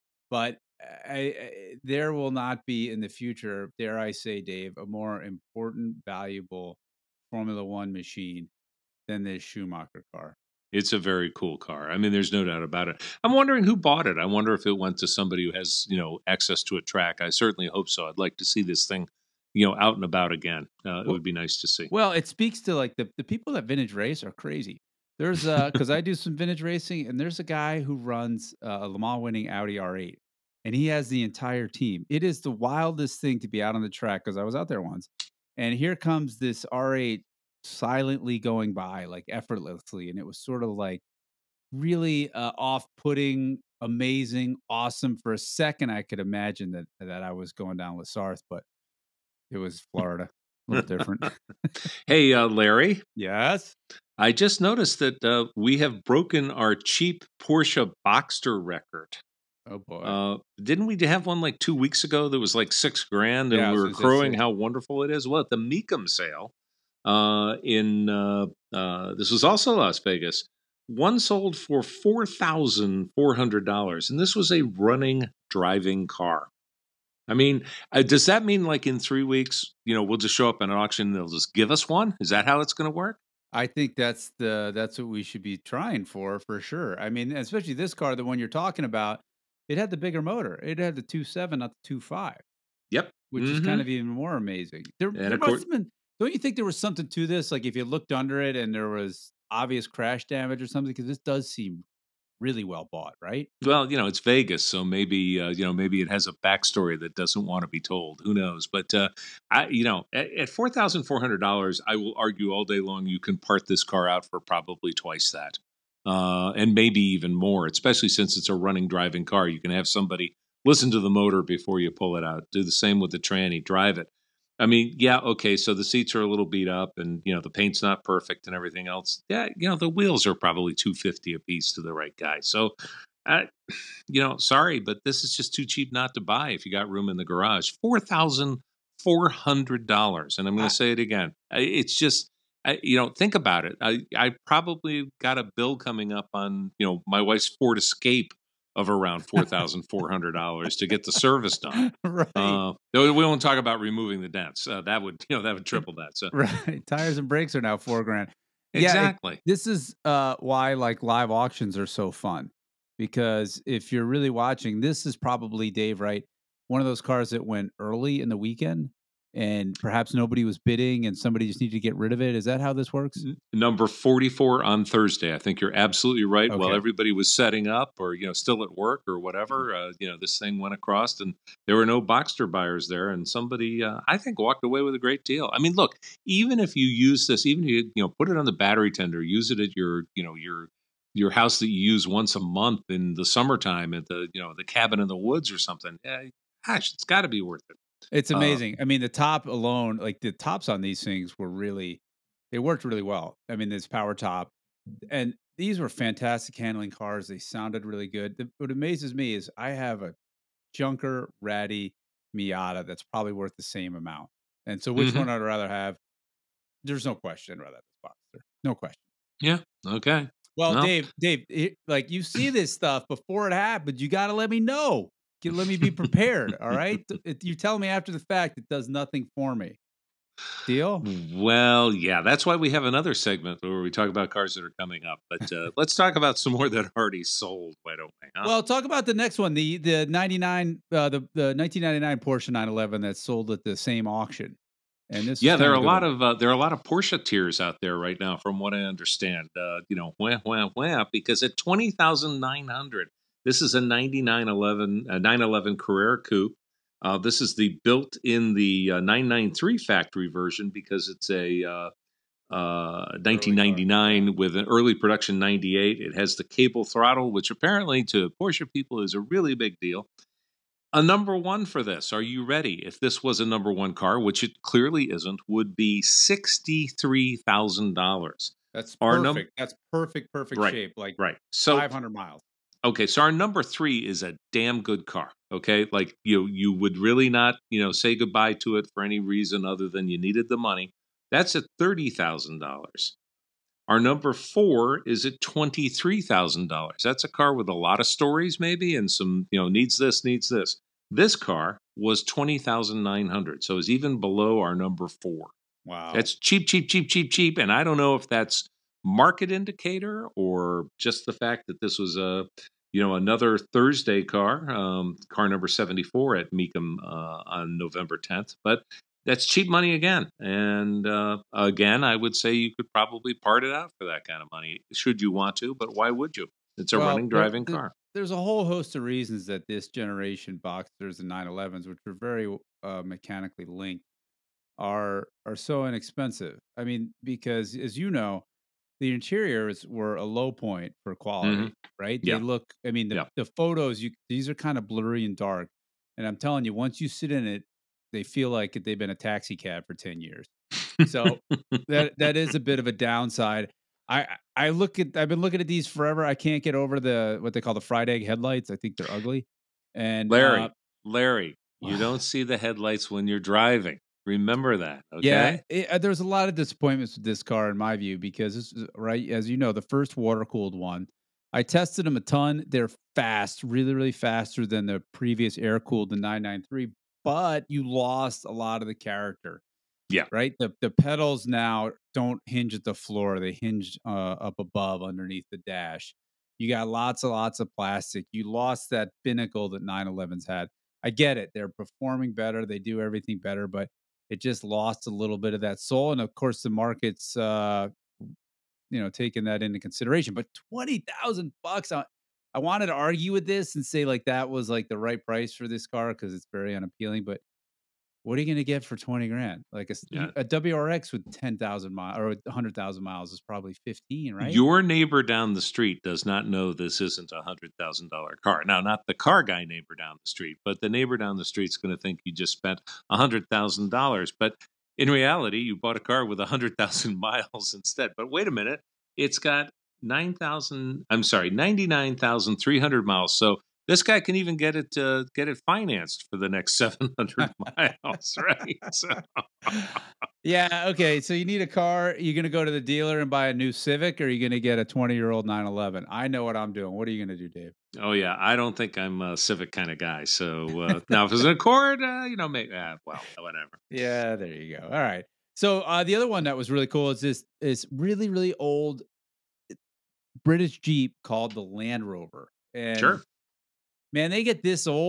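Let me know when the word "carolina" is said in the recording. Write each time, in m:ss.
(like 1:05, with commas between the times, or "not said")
not said.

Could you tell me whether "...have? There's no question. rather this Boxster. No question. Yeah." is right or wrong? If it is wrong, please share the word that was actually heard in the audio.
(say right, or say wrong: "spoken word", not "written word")
right.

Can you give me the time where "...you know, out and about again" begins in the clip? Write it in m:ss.
0:19.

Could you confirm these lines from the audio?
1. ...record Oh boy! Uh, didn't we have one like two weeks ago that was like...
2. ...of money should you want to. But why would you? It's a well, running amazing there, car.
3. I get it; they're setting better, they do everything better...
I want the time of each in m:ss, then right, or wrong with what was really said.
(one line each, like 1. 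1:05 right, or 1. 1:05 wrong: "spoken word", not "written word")
1. 0:58 right
2. 5:24 wrong: "driving", not "amazing"
3. 6:31 wrong: "performing", not "setting".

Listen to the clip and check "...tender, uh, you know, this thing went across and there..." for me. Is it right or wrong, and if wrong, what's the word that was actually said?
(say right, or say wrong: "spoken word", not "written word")
wrong: "whatever", not "tender".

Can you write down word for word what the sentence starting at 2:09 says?
Yeah, you know, the wheels are probably 250 a piece to the right guy.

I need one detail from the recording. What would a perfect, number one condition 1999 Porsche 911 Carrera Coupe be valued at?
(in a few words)
$63,000.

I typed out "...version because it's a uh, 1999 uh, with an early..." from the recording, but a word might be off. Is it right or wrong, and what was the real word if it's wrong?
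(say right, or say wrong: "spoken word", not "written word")
right.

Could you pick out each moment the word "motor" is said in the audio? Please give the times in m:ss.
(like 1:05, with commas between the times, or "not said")
1:30, 2:01.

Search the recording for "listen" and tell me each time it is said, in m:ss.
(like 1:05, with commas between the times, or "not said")
2:00.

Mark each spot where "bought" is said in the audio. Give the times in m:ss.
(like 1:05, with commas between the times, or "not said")
0:13, 1:42, 7:05.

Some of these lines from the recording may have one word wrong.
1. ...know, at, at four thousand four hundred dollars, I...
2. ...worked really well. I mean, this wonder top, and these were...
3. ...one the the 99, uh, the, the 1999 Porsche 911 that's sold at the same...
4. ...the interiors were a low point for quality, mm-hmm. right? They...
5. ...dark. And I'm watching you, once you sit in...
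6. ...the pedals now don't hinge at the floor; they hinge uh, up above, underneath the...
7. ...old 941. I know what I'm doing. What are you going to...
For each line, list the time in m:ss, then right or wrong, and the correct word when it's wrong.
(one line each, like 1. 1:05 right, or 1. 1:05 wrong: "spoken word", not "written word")
1. 1:49 right
2. 3:22 wrong: "power", not "wonder"
3. 3:59 right
4. 5:39 right
5. 5:45 wrong: "telling", not "watching"
6. 6:20 right
7. 7:25 wrong: "911", not "941".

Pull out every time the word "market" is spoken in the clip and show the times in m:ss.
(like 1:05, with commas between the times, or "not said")
5:09, 6:36.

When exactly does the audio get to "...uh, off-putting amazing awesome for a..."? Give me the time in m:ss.
0:42.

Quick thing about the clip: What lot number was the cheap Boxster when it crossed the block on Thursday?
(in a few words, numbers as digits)
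44.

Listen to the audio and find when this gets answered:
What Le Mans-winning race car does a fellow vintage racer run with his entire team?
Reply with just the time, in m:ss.
0:29.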